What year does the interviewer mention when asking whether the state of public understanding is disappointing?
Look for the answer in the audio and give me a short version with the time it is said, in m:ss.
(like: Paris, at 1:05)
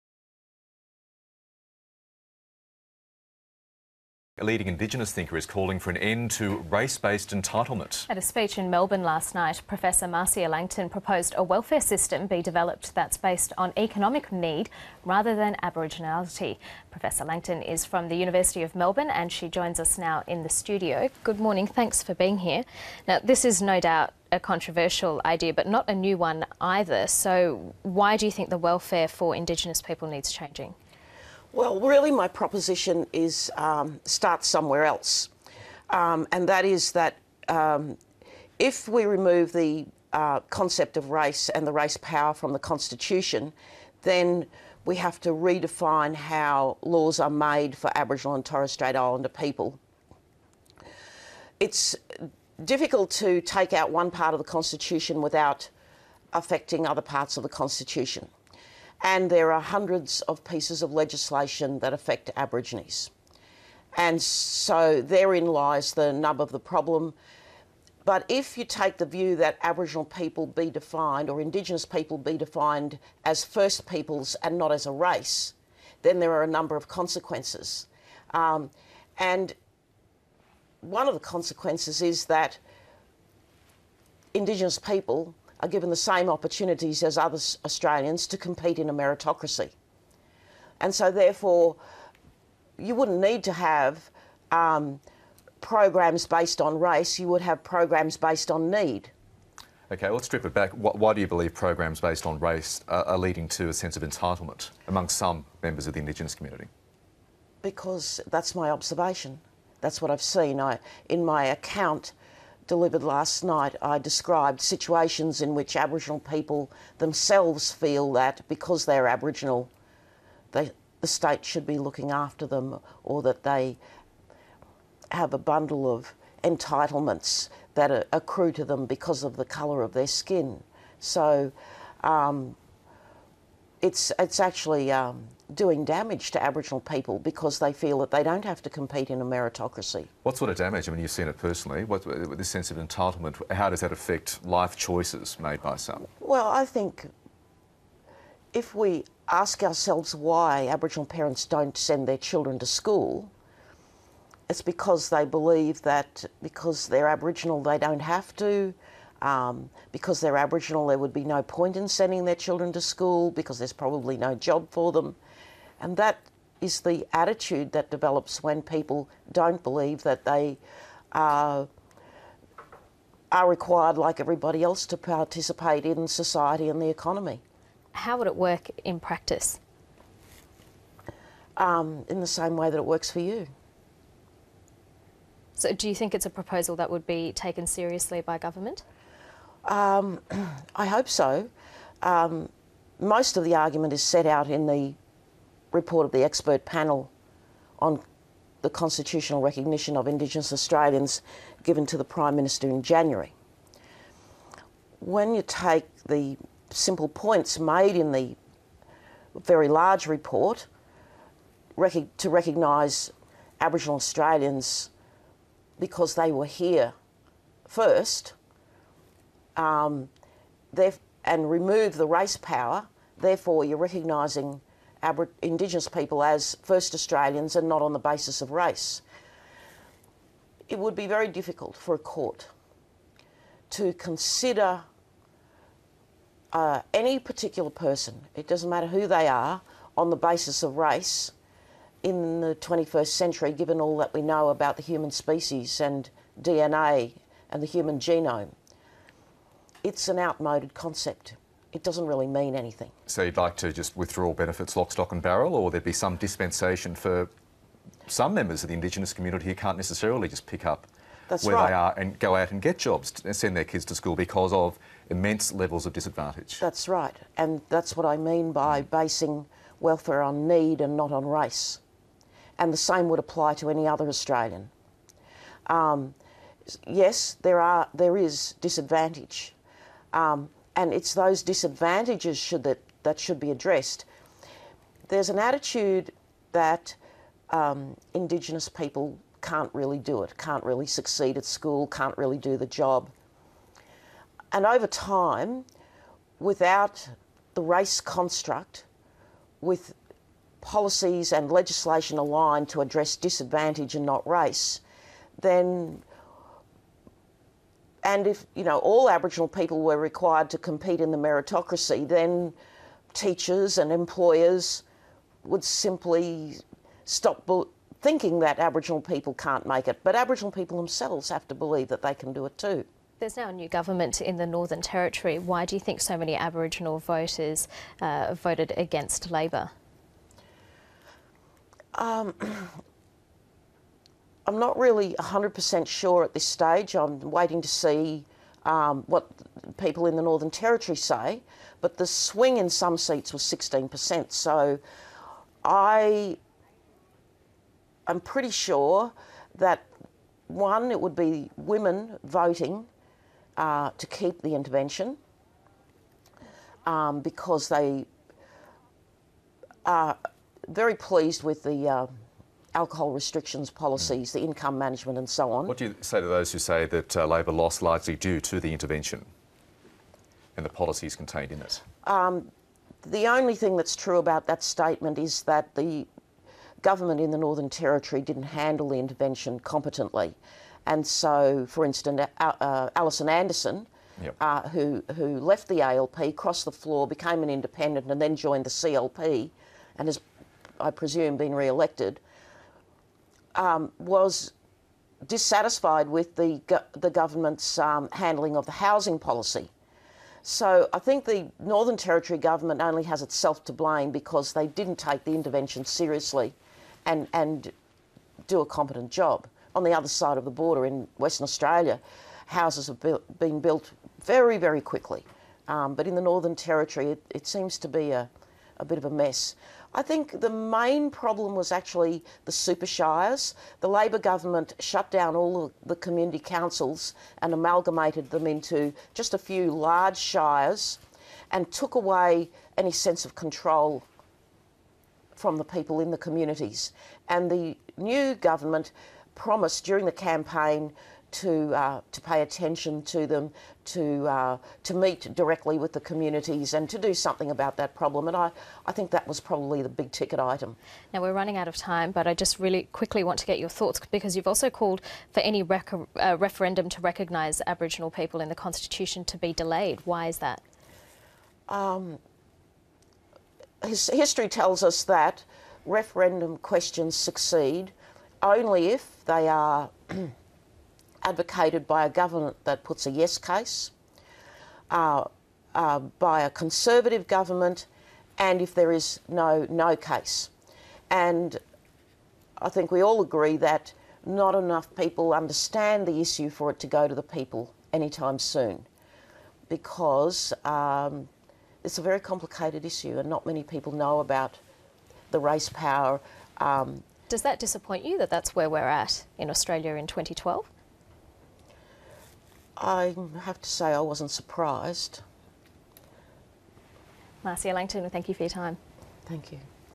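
2012, at 8:20.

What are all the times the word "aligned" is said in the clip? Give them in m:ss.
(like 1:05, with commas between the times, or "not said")
5:02.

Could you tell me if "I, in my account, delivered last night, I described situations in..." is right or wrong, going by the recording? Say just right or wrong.
right.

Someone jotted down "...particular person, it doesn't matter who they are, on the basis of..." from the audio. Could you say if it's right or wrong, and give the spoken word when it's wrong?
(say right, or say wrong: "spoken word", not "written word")
right.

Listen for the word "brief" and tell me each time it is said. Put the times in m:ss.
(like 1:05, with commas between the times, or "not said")
not said.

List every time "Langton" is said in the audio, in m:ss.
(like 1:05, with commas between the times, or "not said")
0:10, 0:17, 8:27.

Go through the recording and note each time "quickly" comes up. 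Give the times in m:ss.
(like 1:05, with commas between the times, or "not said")
6:54, 7:32.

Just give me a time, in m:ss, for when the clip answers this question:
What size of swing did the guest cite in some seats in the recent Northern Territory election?
5:43.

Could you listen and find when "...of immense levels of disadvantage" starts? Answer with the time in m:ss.
4:24.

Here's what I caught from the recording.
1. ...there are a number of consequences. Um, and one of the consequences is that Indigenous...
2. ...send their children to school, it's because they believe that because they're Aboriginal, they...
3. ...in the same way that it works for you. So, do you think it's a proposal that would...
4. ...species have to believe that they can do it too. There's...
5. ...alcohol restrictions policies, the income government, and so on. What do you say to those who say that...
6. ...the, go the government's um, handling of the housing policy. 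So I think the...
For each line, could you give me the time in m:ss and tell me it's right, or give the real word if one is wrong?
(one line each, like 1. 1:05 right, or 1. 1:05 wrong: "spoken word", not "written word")
1. 1:16 right
2. 2:31 right
3. 3:02 right
4. 5:20 wrong: "themselves", not "species"
5. 6:02 wrong: "management", not "government"
6. 6:36 right.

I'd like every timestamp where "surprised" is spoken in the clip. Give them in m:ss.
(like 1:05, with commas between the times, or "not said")
8:24.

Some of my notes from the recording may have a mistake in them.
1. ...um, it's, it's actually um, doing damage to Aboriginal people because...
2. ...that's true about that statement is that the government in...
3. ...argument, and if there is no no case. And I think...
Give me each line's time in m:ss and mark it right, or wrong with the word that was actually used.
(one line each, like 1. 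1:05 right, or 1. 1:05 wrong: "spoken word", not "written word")
1. 2:12 right
2. 6:13 right
3. 7:57 wrong: "government", not "argument".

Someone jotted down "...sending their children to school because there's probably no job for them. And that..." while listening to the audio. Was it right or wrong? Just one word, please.
right.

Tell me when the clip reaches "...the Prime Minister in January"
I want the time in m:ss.
3:21.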